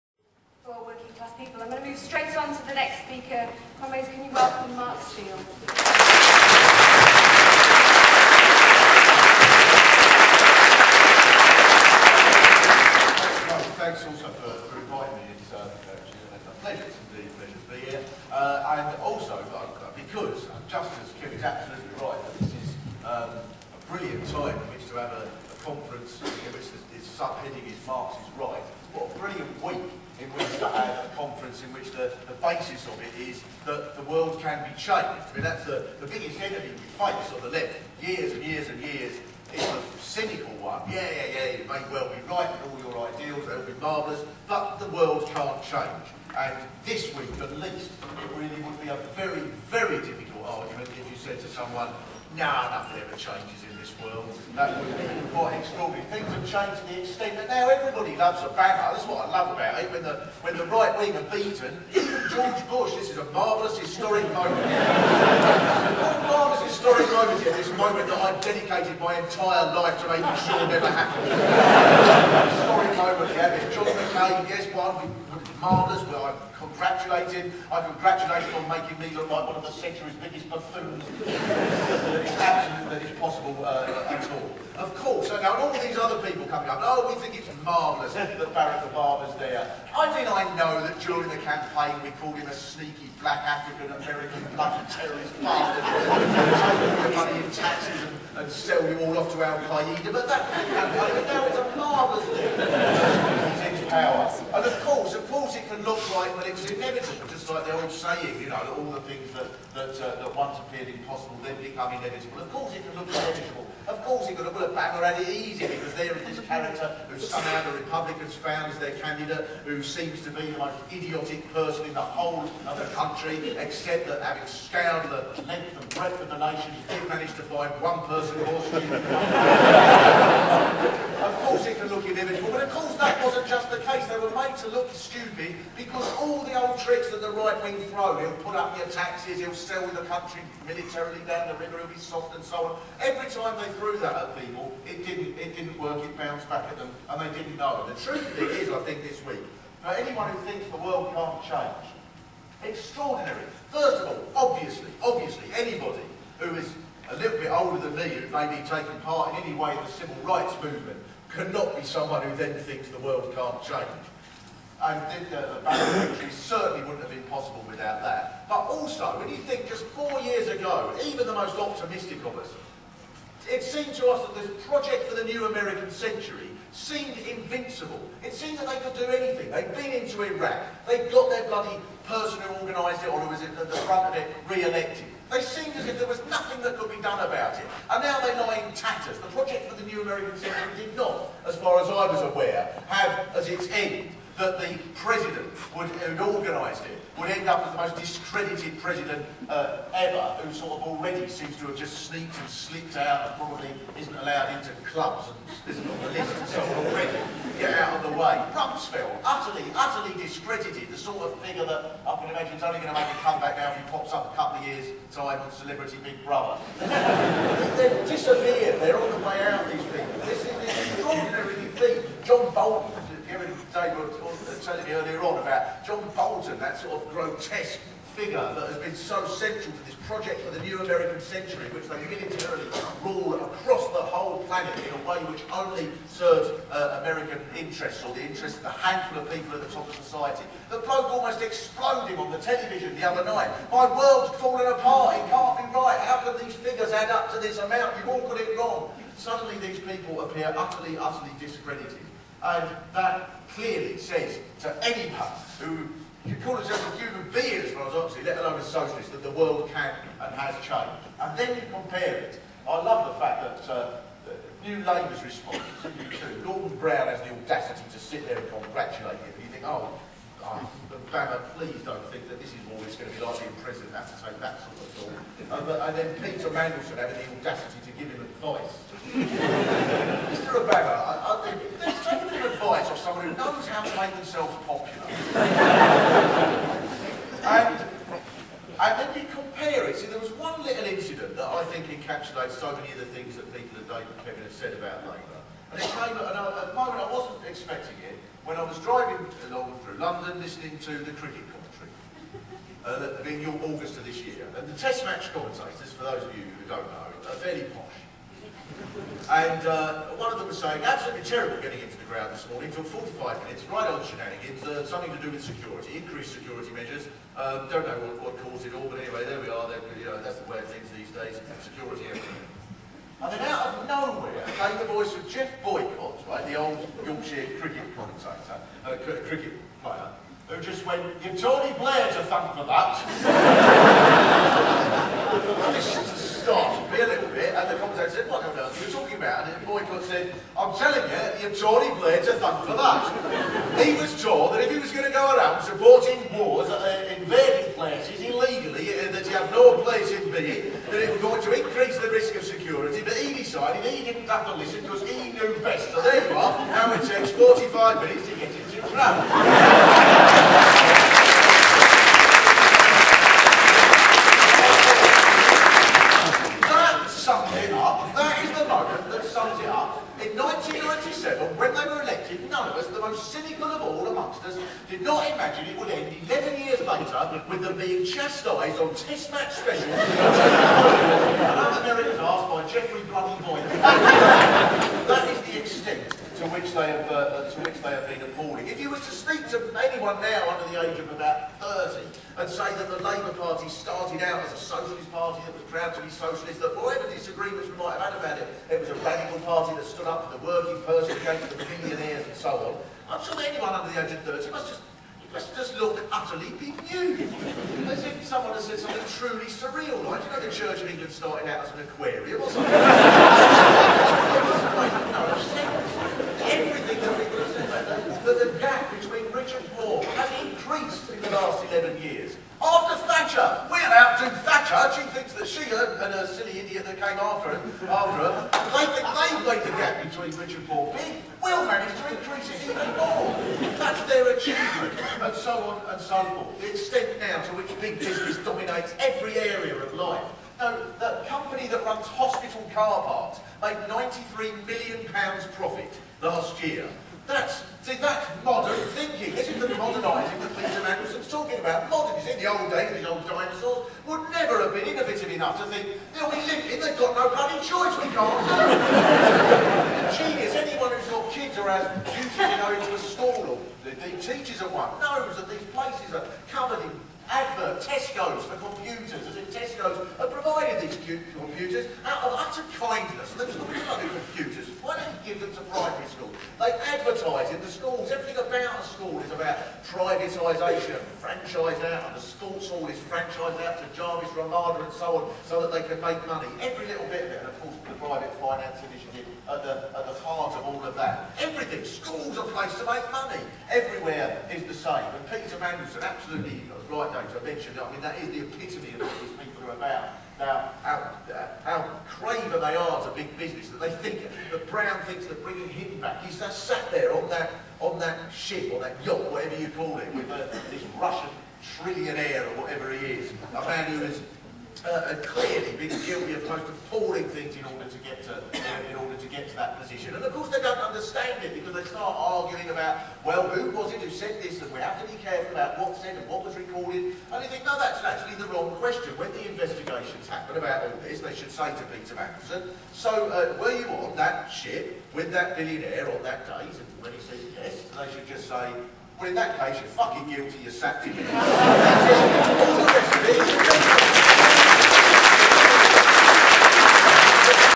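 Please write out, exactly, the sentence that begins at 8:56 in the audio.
And when he says yes, they should just say, well, in that case, you're fucking guilty, you're sacked.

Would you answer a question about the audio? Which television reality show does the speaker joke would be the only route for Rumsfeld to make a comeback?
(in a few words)
Celebrity Big Brother.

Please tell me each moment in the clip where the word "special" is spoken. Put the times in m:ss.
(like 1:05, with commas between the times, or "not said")
6:19.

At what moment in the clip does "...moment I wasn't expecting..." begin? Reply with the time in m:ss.
4:56.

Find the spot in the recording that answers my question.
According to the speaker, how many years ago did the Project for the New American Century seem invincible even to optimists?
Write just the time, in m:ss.
2:49.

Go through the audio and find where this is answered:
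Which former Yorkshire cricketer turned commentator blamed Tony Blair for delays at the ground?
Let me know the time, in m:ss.
5:25.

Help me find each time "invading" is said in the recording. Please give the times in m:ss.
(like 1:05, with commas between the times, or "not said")
5:47.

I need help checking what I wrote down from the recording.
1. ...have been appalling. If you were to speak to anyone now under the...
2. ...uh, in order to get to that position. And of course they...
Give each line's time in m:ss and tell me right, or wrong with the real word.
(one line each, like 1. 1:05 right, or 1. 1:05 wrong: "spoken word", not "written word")
1. 6:27 right
2. 8:38 right.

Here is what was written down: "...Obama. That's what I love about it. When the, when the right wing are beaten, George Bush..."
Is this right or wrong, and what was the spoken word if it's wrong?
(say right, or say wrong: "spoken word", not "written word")
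right.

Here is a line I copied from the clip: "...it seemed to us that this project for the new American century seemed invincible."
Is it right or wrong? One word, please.
right.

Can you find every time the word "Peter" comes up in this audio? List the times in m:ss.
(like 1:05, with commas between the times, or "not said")
4:36, 7:30, 8:15, 8:51.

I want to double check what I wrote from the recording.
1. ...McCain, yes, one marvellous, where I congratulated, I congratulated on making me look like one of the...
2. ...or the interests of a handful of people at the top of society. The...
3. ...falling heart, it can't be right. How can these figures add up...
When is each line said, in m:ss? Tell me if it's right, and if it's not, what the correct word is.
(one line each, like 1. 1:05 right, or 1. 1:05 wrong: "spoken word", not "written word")
1. 1:13 right
2. 3:58 right
3. 4:04 wrong: "apart", not "heart".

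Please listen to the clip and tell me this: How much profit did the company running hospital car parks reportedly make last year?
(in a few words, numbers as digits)
£93 million.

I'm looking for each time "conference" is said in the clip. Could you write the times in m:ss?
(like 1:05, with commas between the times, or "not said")
0:25, 0:31.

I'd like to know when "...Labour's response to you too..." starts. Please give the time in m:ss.
4:24.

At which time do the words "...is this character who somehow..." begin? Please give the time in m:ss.
1:56.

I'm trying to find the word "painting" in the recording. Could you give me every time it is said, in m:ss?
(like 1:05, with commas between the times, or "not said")
not said.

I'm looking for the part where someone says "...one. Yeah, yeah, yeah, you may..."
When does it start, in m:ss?
0:40.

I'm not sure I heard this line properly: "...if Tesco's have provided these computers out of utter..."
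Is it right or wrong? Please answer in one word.
right.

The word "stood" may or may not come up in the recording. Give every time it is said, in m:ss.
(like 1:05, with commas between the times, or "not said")
6:39.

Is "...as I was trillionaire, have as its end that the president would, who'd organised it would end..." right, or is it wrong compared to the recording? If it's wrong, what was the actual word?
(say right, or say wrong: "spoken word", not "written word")
wrong: "aware", not "trillionaire".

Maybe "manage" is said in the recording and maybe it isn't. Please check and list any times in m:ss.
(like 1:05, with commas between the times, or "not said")
2:07, 7:11.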